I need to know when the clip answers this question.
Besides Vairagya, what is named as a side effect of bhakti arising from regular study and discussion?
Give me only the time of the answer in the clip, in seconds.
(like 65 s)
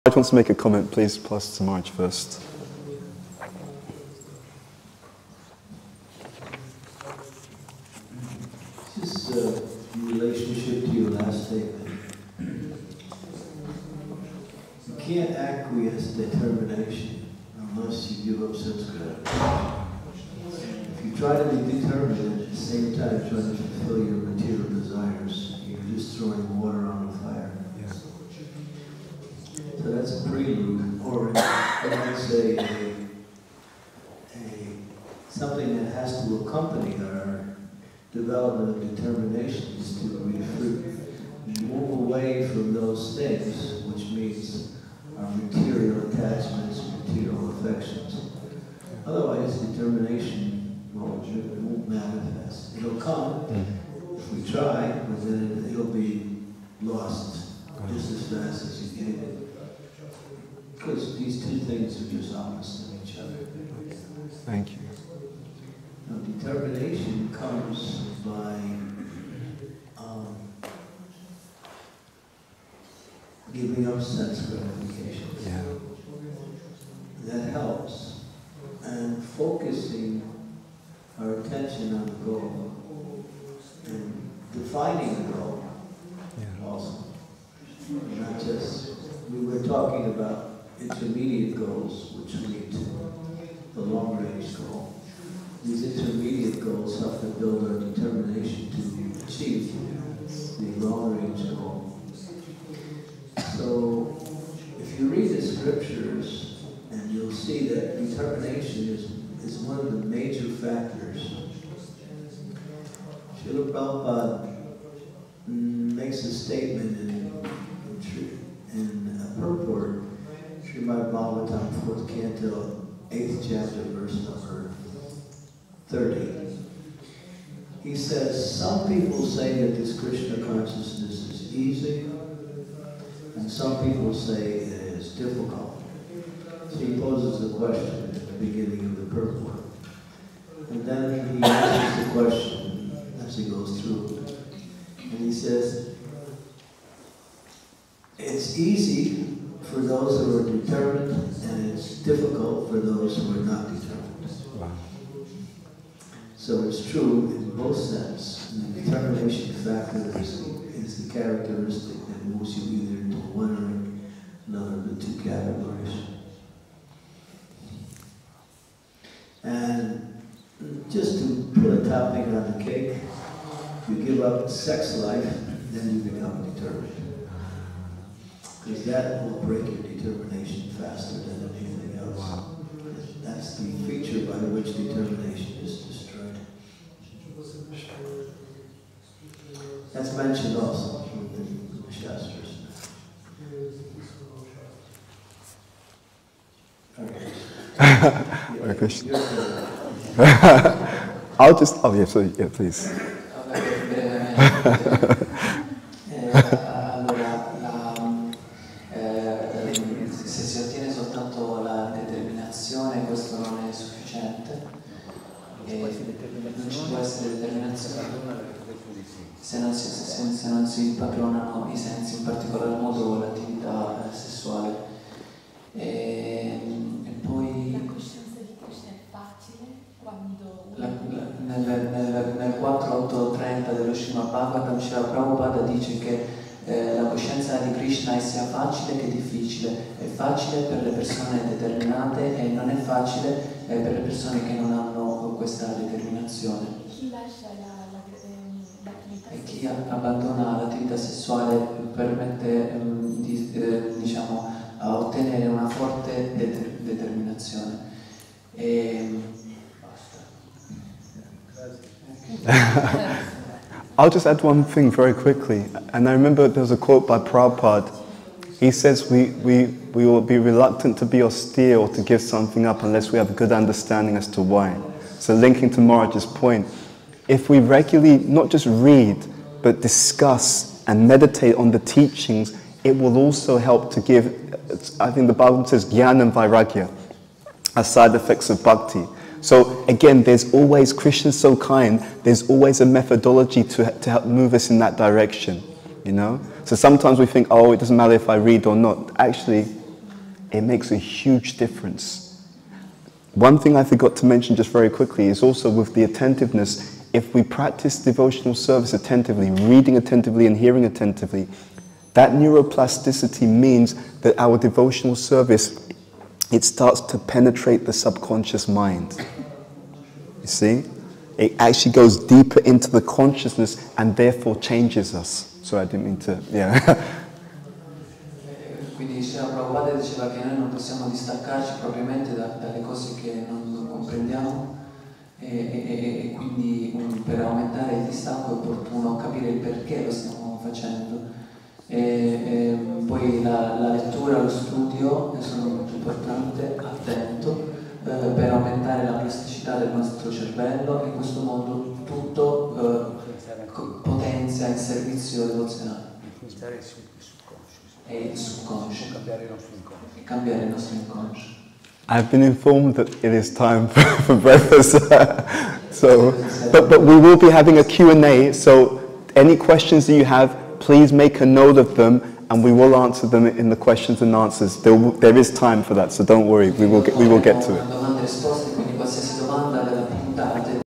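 285 s.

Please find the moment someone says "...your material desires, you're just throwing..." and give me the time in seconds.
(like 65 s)
23 s.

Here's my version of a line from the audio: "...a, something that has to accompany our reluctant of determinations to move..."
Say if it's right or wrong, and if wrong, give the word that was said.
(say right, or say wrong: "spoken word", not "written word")
wrong: "development", not "reluctant".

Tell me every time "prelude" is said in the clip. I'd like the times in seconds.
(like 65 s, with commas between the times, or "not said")
30 s.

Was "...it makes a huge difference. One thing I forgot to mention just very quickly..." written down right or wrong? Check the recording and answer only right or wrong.
right.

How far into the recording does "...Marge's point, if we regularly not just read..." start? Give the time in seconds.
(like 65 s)
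275 s.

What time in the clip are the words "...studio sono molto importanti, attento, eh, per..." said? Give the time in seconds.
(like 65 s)
344 s.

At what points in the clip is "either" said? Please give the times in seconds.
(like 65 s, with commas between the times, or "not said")
162 s.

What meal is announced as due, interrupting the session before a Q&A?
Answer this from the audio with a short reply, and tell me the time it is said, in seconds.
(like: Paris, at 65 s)
breakfast, at 364 s.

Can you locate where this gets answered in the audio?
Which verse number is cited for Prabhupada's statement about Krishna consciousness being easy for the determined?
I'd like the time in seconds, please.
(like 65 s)
123 s.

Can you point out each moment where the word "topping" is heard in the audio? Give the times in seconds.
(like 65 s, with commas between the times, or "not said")
171 s.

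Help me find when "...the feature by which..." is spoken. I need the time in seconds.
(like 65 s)
183 s.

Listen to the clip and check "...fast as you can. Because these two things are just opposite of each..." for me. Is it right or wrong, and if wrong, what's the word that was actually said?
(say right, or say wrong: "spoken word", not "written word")
right.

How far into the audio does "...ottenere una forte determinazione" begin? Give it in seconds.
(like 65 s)
254 s.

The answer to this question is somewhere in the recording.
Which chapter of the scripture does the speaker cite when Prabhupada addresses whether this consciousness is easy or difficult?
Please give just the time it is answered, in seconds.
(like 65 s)
123 s.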